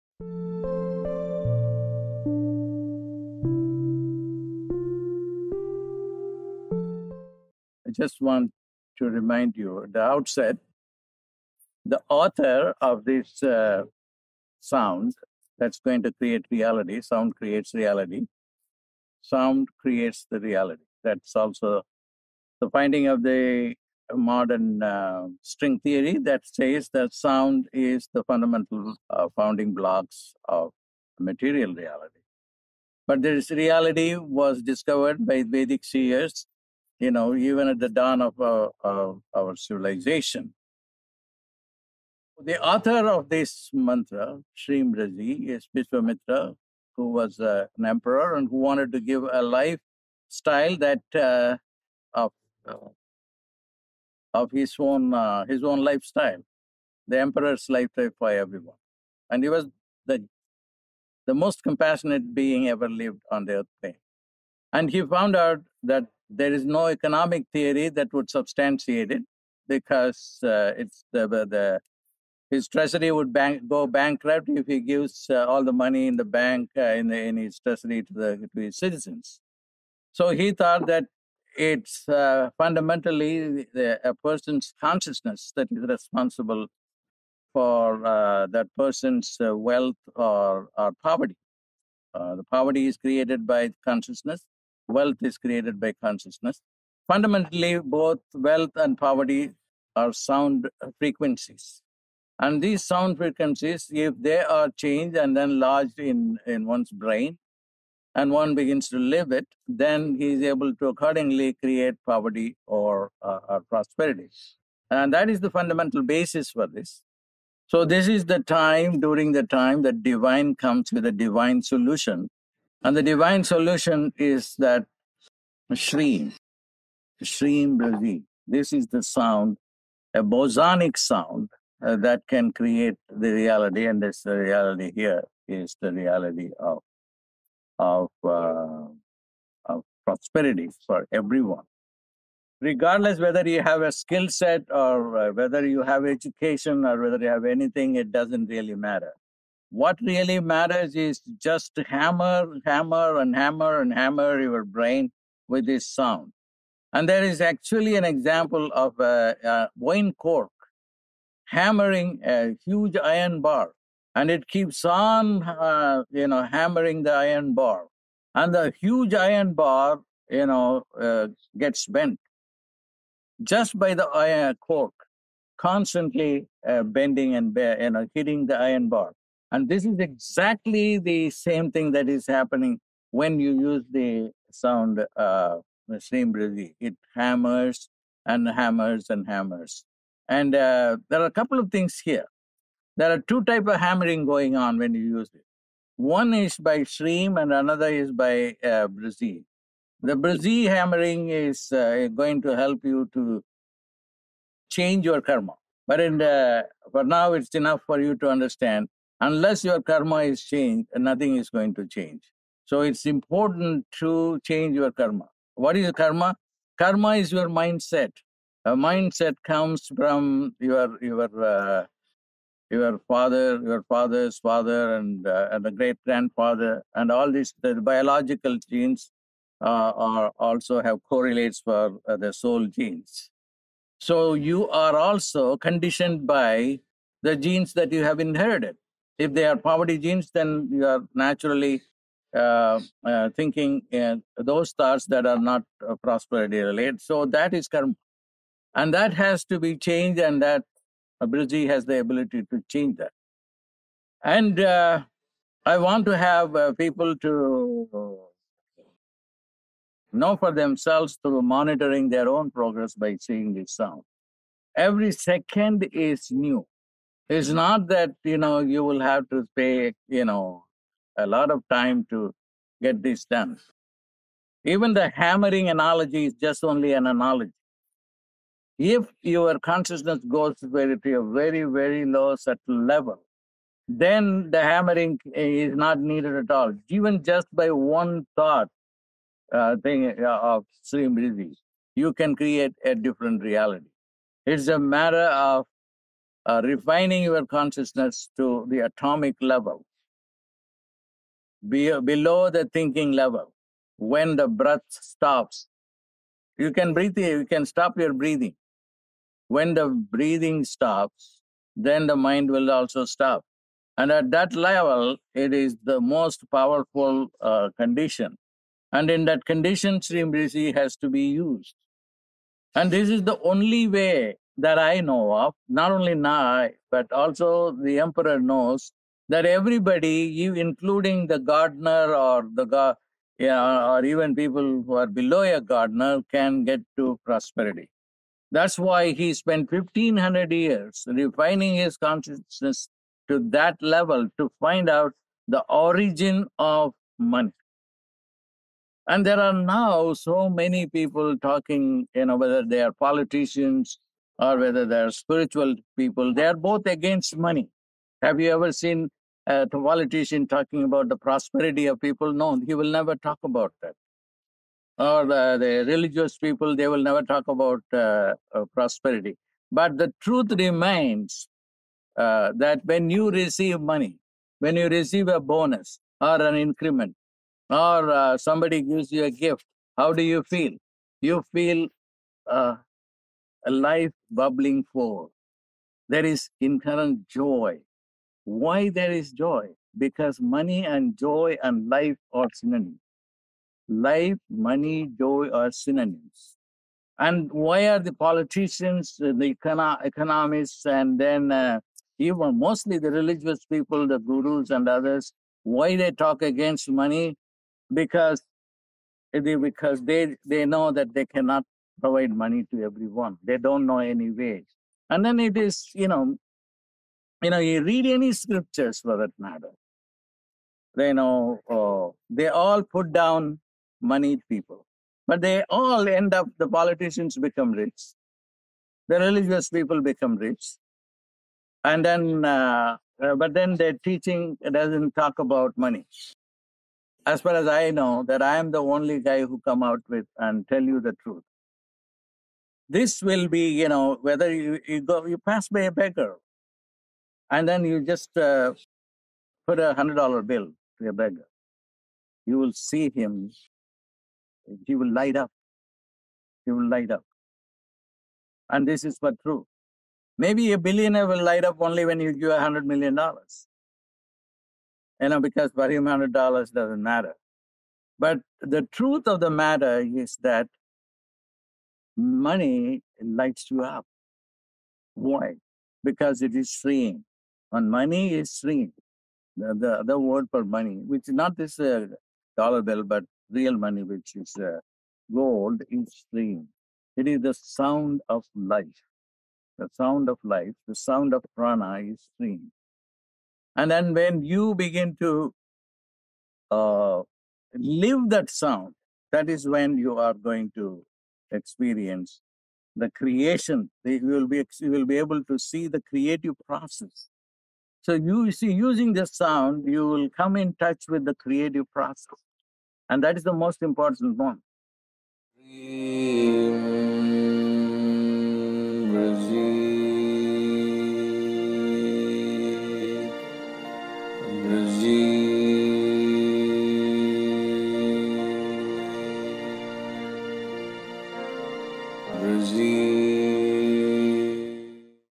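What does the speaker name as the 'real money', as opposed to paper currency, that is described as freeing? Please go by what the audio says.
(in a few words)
gold.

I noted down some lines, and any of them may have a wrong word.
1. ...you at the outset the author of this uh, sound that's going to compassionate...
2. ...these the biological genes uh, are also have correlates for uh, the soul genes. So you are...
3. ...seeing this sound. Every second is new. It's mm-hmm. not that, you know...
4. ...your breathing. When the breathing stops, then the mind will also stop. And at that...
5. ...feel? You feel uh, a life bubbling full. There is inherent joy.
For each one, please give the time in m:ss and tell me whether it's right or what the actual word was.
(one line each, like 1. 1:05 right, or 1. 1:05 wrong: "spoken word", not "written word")
1. 0:09 wrong: "create", not "compassionate"
2. 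3:47 right
3. 4:23 right
4. 5:07 right
5. 6:20 right.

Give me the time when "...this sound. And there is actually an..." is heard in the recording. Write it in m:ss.
2:35.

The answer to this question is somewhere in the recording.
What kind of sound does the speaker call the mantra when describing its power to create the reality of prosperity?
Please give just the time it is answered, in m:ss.
2:10.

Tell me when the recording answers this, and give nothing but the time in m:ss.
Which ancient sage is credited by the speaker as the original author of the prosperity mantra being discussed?
0:45.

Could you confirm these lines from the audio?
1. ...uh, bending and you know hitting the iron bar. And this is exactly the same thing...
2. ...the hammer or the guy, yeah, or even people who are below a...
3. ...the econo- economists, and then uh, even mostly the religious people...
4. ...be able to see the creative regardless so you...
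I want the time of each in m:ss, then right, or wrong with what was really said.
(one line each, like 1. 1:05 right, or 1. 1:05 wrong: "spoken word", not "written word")
1. 2:56 right
2. 5:31 wrong: "gardener", not "hammer"
3. 6:39 right
4. 8:25 wrong: "process", not "regardless".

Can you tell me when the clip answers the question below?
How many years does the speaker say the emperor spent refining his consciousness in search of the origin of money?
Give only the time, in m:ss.
5:39.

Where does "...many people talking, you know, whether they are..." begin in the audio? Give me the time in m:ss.
5:50.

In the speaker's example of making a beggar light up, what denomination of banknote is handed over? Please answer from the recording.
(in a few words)
hundred dollar bill.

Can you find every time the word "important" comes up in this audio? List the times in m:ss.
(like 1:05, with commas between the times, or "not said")
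3:33, 8:33.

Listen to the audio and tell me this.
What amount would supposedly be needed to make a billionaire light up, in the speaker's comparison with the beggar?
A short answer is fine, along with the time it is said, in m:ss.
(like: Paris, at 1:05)
100 million dollars, at 7:42.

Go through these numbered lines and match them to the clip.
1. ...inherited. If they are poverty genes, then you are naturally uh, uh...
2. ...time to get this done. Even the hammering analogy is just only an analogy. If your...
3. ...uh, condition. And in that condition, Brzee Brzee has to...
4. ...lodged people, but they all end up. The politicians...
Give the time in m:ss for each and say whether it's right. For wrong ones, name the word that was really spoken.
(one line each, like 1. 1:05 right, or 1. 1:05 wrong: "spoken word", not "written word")
1. 3:58 right
2. 4:31 right
3. 5:17 wrong: "Shreem", not "Brzee"
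4. 7:04 wrong: "moneyed", not "lodged".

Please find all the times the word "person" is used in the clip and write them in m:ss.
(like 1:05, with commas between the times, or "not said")
1:24, 1:28.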